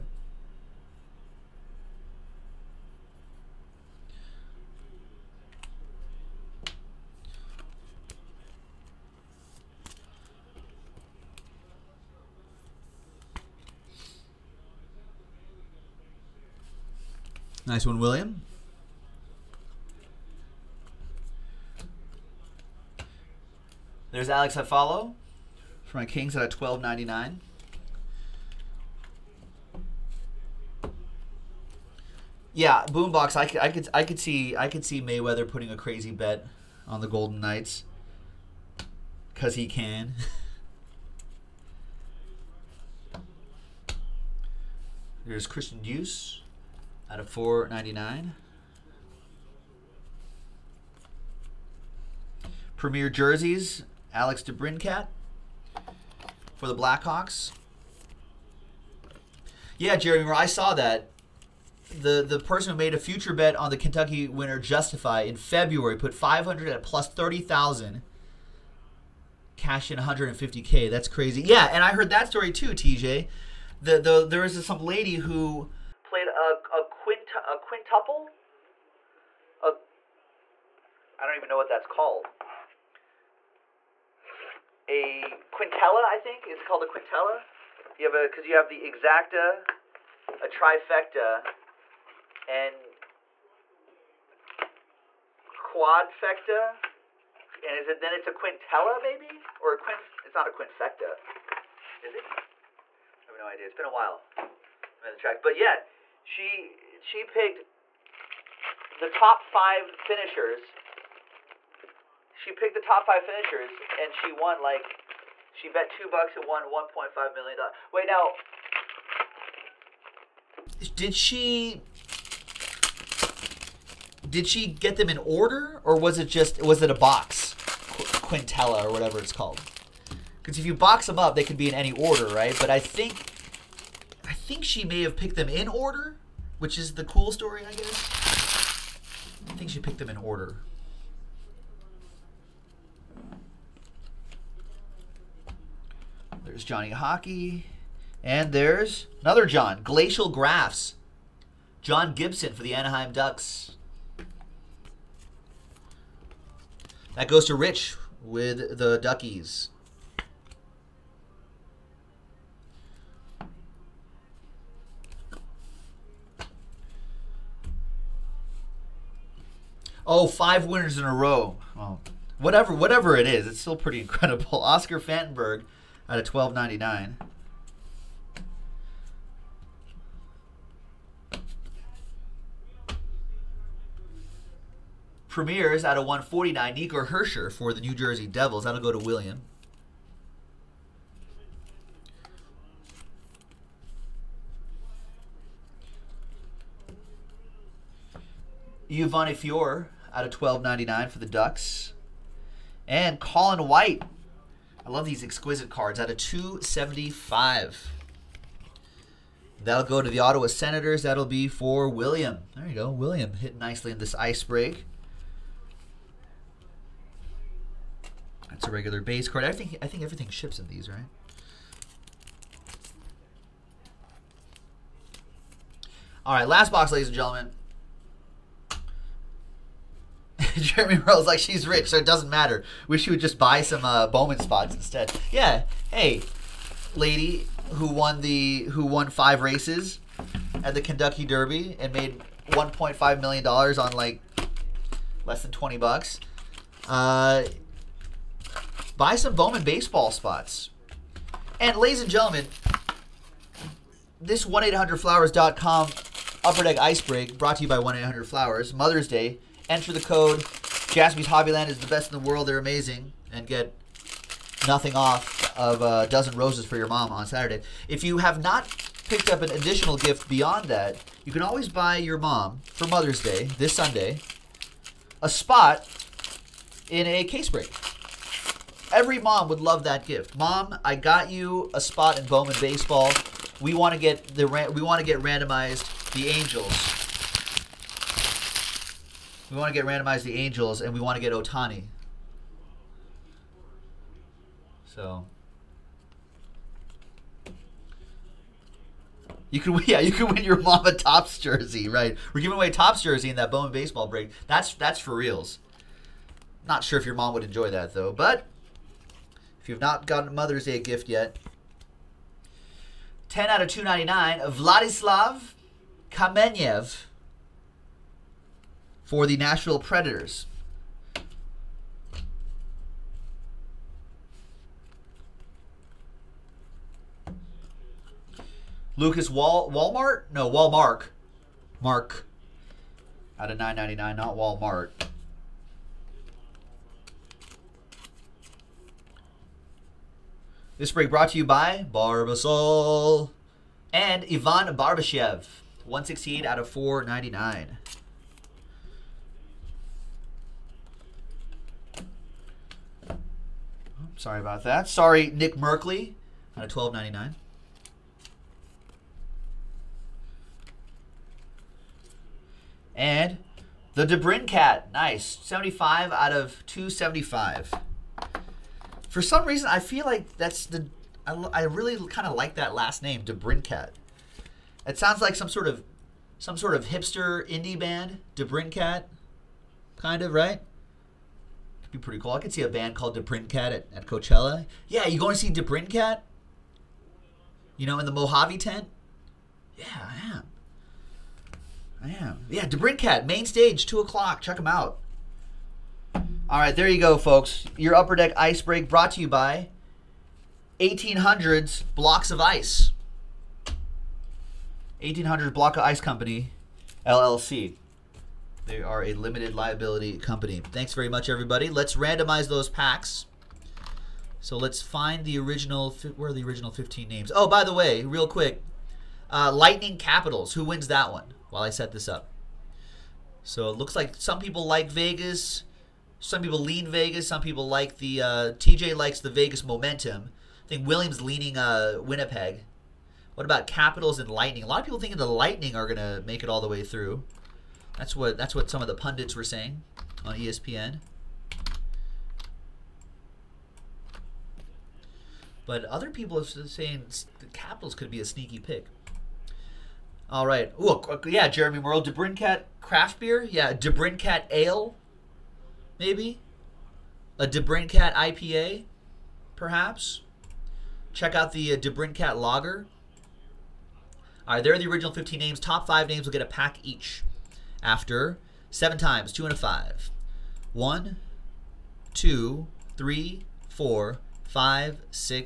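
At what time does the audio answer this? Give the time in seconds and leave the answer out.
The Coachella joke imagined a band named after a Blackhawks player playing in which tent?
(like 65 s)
388 s.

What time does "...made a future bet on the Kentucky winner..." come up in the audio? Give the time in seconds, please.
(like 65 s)
62 s.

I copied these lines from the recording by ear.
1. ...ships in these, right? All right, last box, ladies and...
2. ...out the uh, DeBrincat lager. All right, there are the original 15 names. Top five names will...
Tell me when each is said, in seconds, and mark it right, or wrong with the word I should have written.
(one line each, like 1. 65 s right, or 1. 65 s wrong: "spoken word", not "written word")
1. 220 s right
2. 461 s right.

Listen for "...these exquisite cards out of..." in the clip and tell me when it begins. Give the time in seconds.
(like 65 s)
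205 s.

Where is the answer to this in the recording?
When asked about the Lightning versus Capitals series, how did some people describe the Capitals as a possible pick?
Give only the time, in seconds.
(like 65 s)
448 s.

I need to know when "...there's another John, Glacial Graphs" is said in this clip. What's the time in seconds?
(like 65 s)
148 s.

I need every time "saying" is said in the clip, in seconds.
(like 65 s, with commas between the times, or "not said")
439 s, 446 s.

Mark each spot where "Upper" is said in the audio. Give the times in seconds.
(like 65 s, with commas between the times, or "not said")
256 s, 397 s.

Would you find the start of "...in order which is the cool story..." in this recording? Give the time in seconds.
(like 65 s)
135 s.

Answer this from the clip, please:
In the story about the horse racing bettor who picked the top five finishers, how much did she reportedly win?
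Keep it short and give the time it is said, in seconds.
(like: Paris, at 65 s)
1.5 million dollars, at 116 s.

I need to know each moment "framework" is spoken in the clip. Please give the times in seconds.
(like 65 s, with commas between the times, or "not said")
not said.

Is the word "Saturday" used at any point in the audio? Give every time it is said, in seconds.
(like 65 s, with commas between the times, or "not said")
267 s.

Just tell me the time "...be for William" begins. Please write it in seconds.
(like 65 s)
211 s.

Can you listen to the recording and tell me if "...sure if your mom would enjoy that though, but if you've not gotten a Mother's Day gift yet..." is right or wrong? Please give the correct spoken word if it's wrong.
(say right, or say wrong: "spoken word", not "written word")
right.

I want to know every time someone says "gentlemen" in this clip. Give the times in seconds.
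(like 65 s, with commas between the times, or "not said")
227 s, 252 s.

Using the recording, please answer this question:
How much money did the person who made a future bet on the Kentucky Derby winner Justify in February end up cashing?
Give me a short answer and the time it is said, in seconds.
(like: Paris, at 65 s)
150k, at 69 s.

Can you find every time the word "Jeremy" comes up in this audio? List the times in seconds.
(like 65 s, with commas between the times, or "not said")
59 s, 230 s, 451 s.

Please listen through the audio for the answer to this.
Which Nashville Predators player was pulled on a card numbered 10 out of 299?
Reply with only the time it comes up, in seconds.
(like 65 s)
314 s.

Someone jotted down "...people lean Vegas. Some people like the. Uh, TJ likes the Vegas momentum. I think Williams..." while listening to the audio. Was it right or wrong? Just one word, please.
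right.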